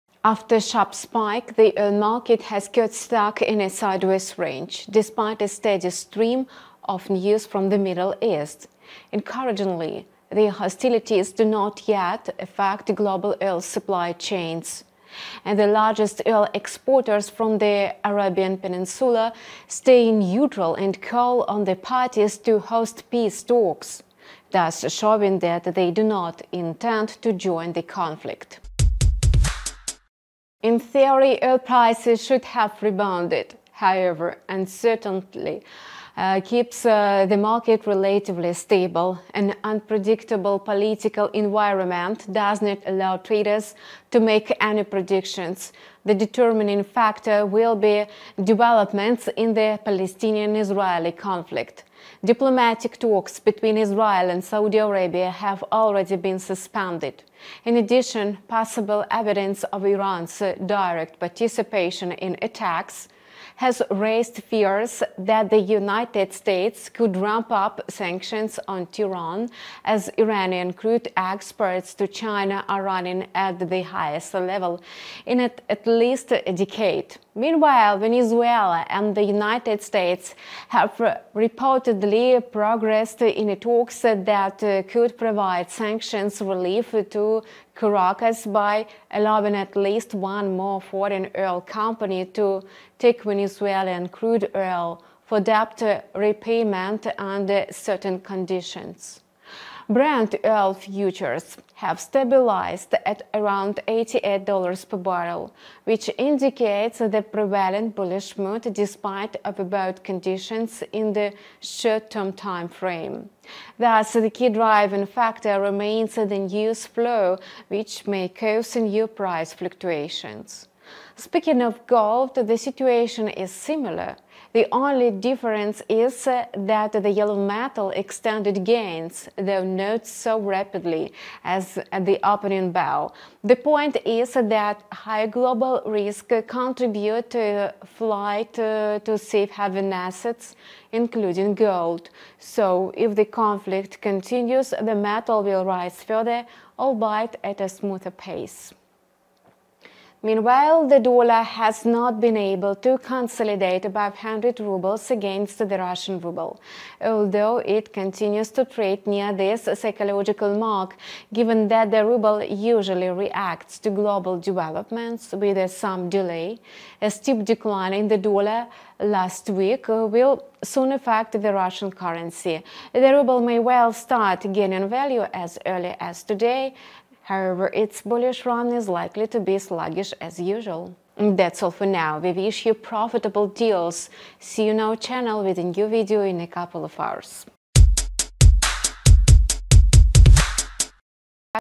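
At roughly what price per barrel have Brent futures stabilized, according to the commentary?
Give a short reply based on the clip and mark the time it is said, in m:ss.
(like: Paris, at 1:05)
$88, at 1:43.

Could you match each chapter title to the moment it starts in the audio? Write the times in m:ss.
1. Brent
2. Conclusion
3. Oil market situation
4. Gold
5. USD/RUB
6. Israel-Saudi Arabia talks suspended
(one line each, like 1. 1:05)
1. 1:39
2. 3:01
3. 0:30
4. 2:00
5. 2:29
6. 0:51.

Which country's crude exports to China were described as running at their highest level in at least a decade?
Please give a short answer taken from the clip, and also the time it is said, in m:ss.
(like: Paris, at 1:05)
Iran, at 1:10.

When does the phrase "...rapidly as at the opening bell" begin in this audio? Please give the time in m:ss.
2:10.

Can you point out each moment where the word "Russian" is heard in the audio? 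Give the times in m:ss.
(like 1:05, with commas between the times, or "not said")
2:35, 2:51.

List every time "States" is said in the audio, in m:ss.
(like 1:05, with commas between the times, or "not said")
1:06, 1:19.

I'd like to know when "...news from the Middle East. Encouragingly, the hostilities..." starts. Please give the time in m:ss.
0:07.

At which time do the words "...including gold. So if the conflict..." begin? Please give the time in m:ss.
2:20.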